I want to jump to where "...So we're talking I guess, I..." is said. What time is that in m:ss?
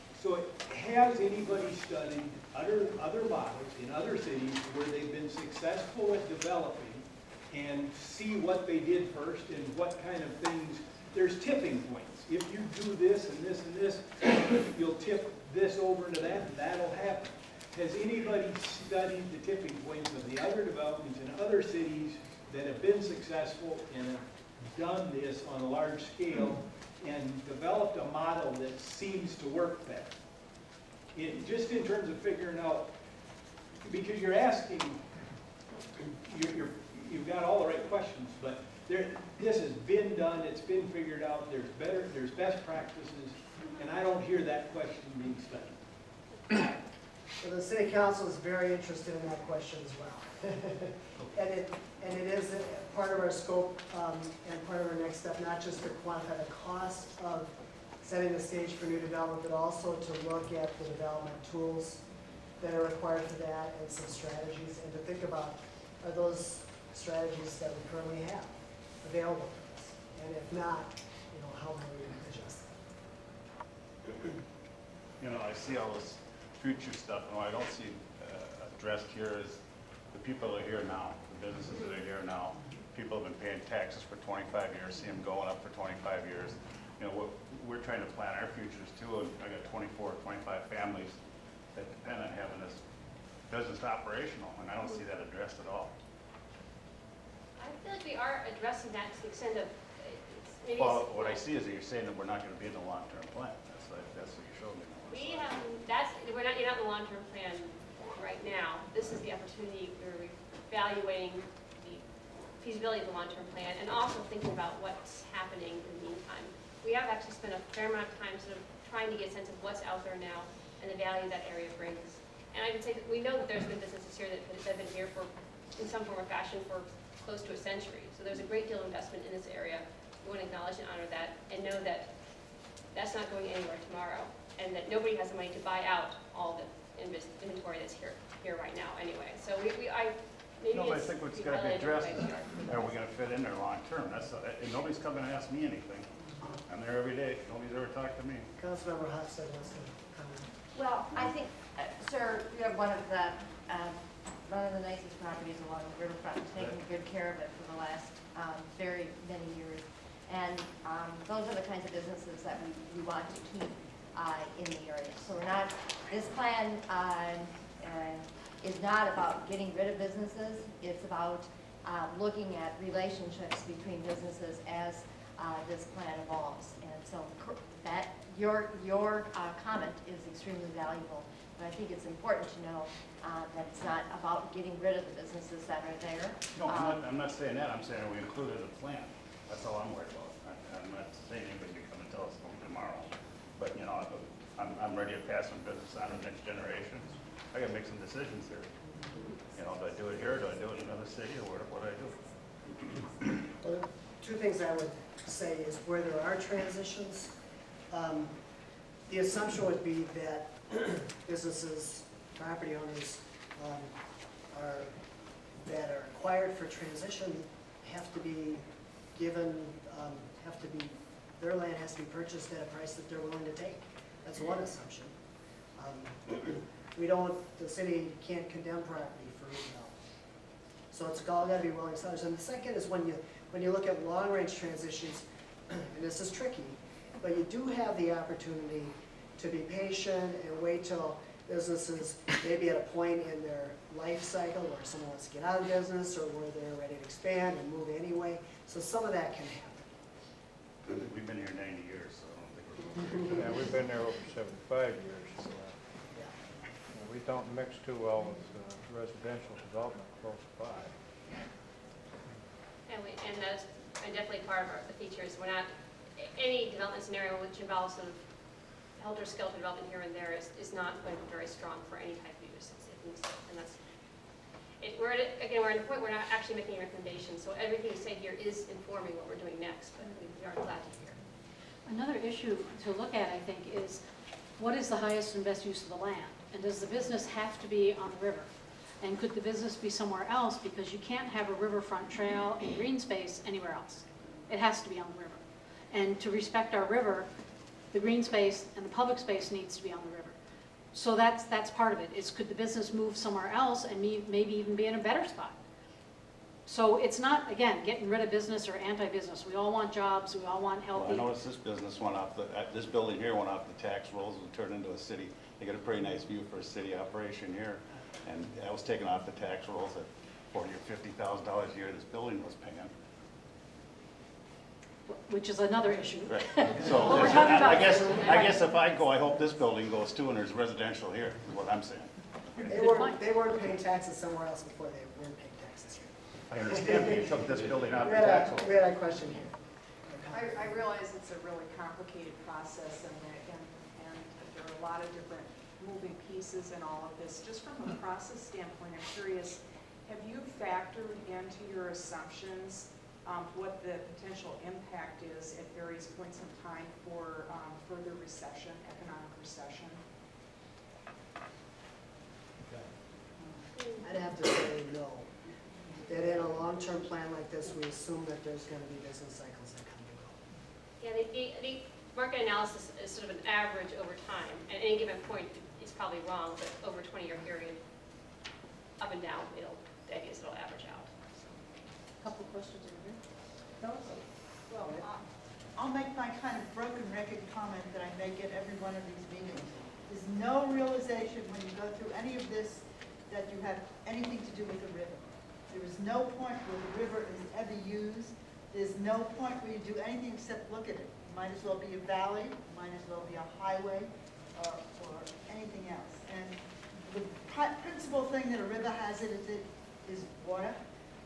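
5:26.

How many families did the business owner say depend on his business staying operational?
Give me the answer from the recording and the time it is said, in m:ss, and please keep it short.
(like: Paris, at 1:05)
24, 25, at 1:29.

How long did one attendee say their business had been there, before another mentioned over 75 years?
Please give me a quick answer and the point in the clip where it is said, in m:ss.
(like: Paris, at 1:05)
90 years, at 4:11.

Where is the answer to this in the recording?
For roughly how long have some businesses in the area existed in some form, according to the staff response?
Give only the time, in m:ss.
2:07.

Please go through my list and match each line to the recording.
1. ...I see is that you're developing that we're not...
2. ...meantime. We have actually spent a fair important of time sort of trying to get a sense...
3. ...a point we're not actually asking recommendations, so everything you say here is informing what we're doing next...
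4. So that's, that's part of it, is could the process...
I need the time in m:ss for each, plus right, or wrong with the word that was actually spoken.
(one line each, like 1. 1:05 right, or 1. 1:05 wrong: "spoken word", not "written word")
1. 1:41 wrong: "saying", not "developing"
2. 1:56 wrong: "amount", not "important"
3. 4:35 wrong: "making", not "asking"
4. 5:00 wrong: "business", not "process".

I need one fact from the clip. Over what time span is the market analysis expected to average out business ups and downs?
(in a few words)
20-year period.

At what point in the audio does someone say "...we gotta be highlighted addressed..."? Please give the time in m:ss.
2:21.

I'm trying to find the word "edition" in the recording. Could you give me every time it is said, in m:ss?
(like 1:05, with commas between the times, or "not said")
not said.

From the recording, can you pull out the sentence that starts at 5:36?
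I understand that you took this building out We had tax a, we had a question here.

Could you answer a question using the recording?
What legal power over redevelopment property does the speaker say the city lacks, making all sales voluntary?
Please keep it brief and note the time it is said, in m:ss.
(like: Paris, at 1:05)
condemn, at 3:48.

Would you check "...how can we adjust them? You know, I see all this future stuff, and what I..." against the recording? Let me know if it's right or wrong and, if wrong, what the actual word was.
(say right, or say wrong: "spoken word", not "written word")
right.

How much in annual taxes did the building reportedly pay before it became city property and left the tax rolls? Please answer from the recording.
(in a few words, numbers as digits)
$40,000 or $50,000.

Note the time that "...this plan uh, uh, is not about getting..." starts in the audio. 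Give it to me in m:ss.
2:46.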